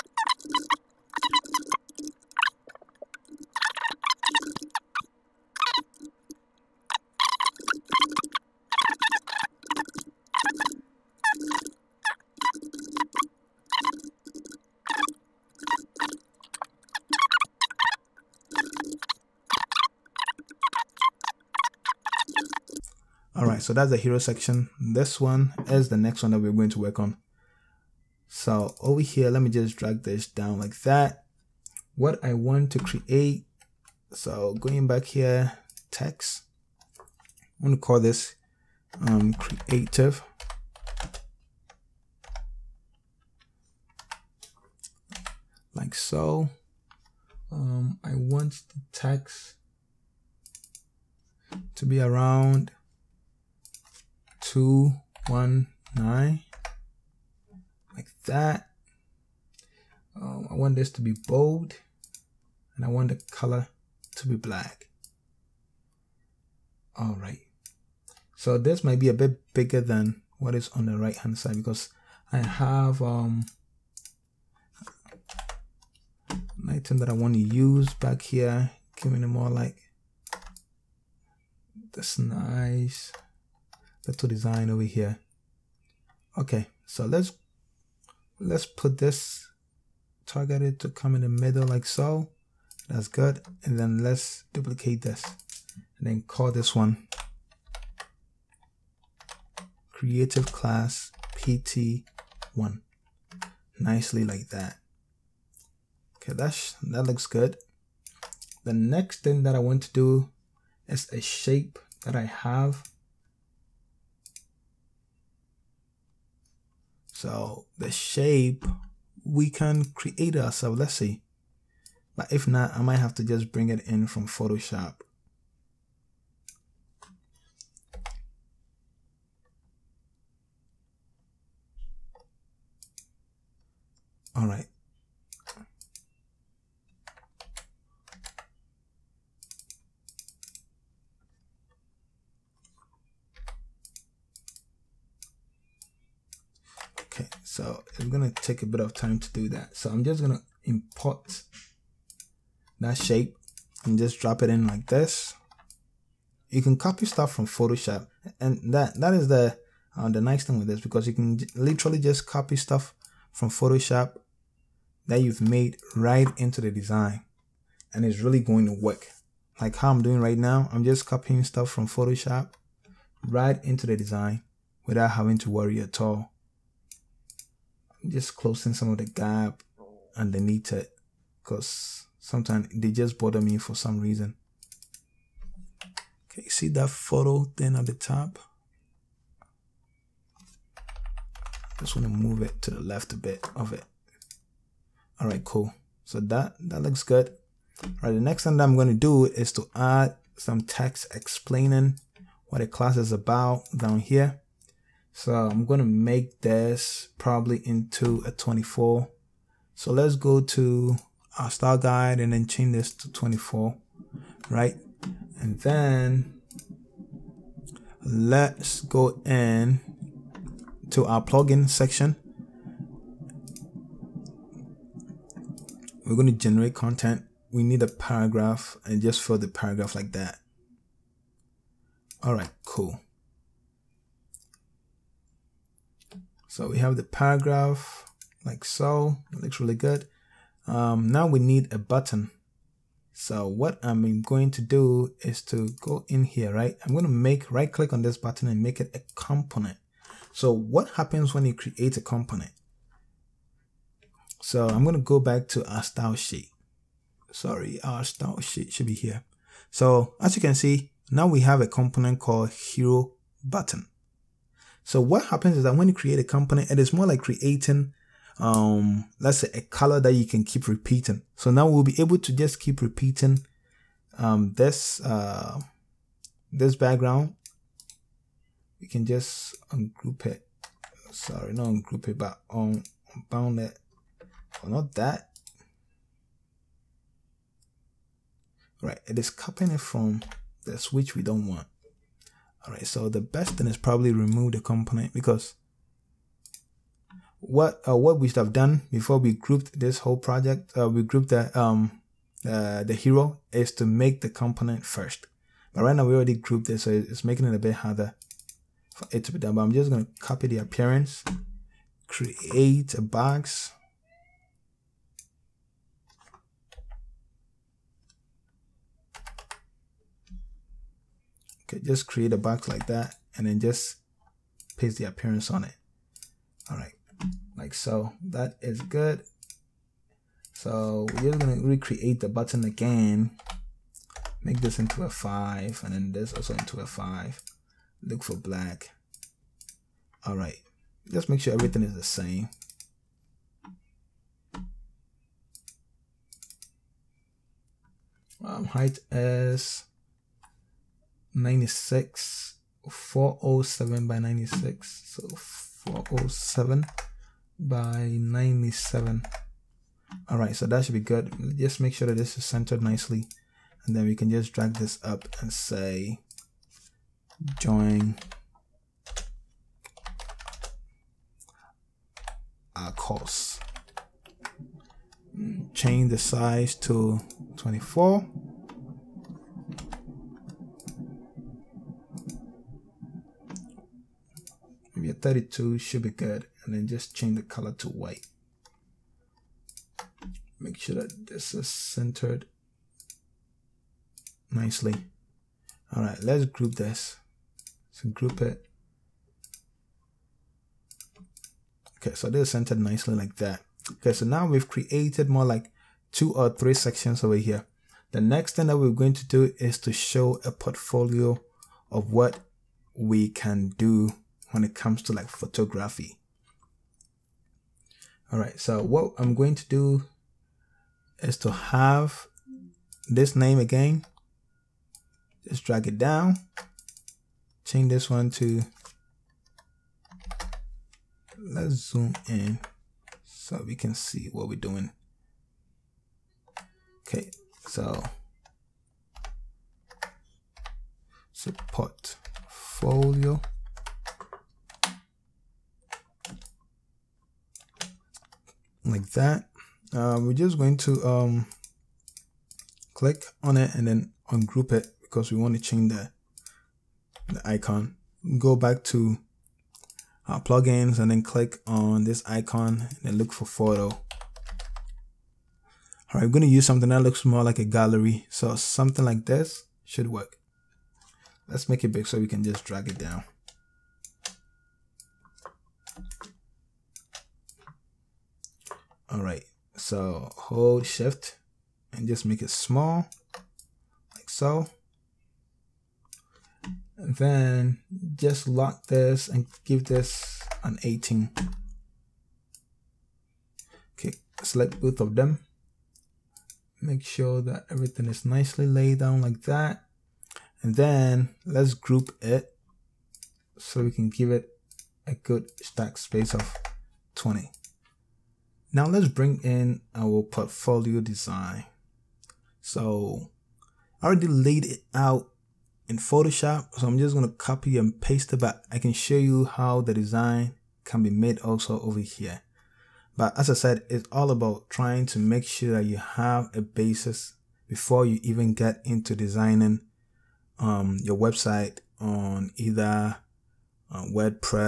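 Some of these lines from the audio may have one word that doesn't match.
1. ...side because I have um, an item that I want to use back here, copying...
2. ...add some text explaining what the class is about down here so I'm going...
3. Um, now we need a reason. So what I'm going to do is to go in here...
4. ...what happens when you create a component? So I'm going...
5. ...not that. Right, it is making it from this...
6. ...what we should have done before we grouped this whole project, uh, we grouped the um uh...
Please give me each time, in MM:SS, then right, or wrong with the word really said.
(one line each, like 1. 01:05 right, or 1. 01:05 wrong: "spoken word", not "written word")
1. 01:11 wrong: "giving", not "copying"
2. 03:19 right
3. 04:00 wrong: "button", not "reason"
4. 04:10 right
5. 04:44 wrong: "copying", not "making"
6. 04:57 right.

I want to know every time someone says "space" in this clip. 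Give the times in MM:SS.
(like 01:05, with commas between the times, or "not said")
08:25.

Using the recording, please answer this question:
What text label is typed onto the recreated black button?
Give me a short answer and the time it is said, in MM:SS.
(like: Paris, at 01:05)
join our course, at 06:07.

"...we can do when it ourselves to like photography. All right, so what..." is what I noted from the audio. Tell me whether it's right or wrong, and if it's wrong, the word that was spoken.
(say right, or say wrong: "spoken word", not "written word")
wrong: "comes", not "ourselves".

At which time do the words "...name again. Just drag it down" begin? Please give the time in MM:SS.
07:03.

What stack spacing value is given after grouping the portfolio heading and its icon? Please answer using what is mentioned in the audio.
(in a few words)
20.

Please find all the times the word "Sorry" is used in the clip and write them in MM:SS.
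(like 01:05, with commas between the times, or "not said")
04:17, 04:41.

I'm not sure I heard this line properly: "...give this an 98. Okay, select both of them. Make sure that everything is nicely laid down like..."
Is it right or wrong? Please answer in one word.
wrong.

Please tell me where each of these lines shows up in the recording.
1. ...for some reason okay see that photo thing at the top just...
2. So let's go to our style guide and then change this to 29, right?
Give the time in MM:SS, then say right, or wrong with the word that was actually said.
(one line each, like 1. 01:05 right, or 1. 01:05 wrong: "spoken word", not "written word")
1. 03:03 right
2. 03:29 wrong: "24", not "29".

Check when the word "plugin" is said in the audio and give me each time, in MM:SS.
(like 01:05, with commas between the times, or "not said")
03:41, 07:40.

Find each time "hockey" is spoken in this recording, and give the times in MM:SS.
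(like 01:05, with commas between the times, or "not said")
not said.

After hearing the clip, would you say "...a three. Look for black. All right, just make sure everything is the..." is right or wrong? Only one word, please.
wrong.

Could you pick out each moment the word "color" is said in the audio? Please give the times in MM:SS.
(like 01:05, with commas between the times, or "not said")
01:03, 04:29, 06:27.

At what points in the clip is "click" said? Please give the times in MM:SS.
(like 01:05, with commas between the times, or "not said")
04:07, 07:32, 07:41.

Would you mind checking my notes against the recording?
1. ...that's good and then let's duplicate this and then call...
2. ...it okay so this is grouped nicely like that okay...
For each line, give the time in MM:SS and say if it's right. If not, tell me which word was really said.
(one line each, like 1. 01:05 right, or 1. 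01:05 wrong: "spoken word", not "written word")
1. 01:32 right
2. 06:38 wrong: "centered", not "grouped".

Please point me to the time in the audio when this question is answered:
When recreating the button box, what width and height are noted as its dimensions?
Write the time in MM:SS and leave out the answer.
05:52.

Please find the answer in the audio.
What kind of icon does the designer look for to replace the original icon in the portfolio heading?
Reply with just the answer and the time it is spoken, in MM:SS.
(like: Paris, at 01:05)
gallery, at 07:47.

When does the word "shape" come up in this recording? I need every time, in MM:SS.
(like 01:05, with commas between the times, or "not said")
01:51, 01:57, 02:32.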